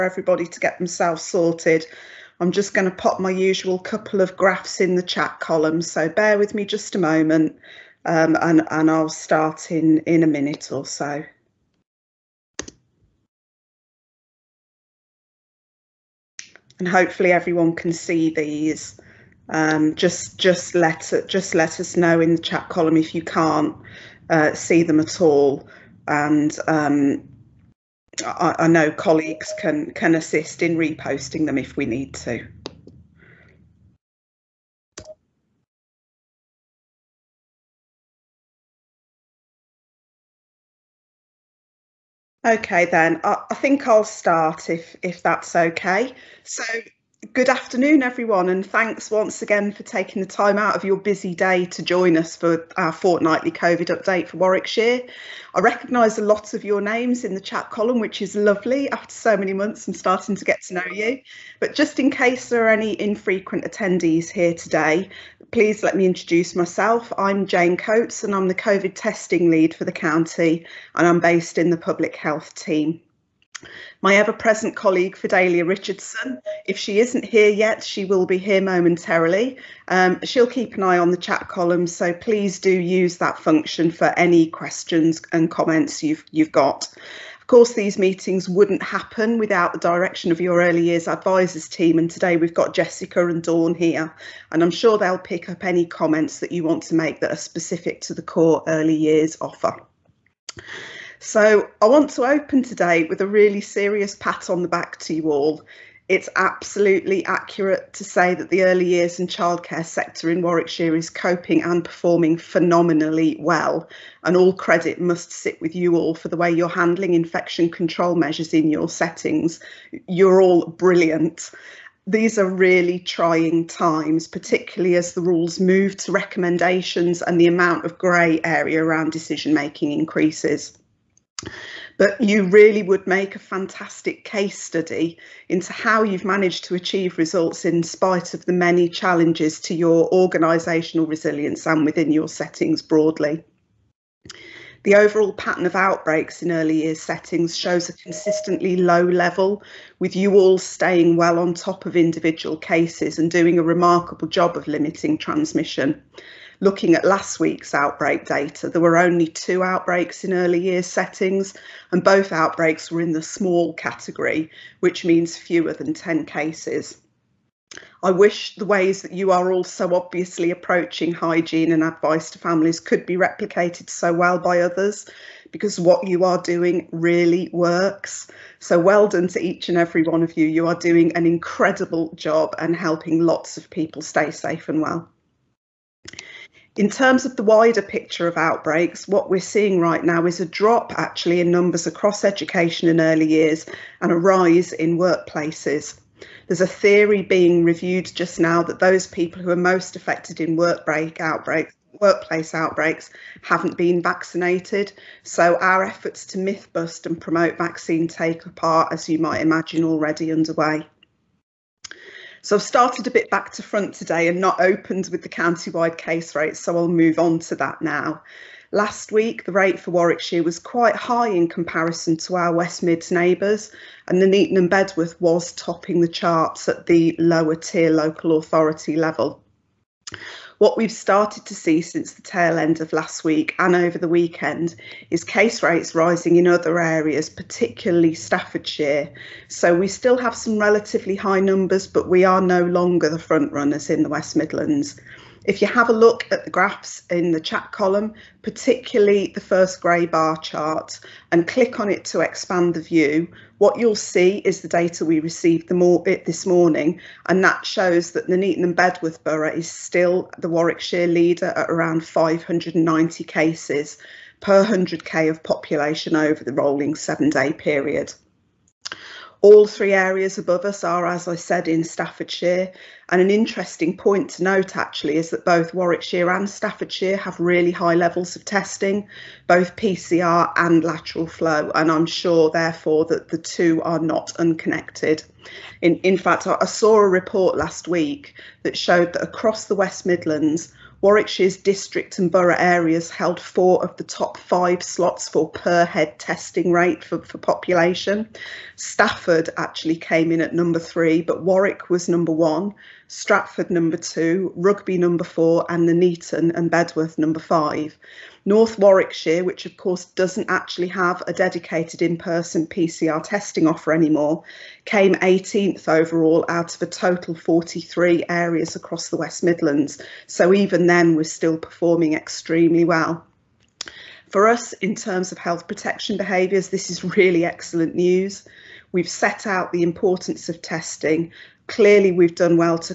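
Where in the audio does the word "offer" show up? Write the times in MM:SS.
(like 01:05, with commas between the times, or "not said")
01:39, 05:13.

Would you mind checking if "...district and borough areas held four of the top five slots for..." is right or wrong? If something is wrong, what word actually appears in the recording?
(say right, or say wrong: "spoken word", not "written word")
right.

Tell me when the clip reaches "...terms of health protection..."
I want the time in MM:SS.
05:24.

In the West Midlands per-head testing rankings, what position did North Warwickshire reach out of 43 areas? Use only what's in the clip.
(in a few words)
18th.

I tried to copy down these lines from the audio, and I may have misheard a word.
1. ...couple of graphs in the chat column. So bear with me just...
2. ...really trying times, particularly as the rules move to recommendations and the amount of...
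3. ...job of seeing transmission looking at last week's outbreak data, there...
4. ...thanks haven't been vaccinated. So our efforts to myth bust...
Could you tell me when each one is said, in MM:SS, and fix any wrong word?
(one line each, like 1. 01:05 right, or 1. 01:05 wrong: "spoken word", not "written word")
1. 00:03 right
2. 02:02 right
3. 02:34 wrong: "limiting", not "seeing"
4. 03:22 wrong: "outbreaks", not "thanks".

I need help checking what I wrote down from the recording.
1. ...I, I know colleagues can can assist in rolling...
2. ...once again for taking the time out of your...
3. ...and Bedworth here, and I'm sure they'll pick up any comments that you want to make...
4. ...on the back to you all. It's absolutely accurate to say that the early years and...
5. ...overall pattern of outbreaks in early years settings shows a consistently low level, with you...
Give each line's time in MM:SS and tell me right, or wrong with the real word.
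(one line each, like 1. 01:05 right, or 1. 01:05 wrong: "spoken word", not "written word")
1. 00:28 wrong: "reposting", not "rolling"
2. 00:49 right
3. 01:33 wrong: "Dawn", not "Bedworth"
4. 01:44 right
5. 02:24 right.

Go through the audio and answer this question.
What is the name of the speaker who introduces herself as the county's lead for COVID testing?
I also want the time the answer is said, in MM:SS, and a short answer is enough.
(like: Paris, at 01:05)
Jane Coates, at 01:07.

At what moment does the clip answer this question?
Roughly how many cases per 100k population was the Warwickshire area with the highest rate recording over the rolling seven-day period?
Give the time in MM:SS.
04:22.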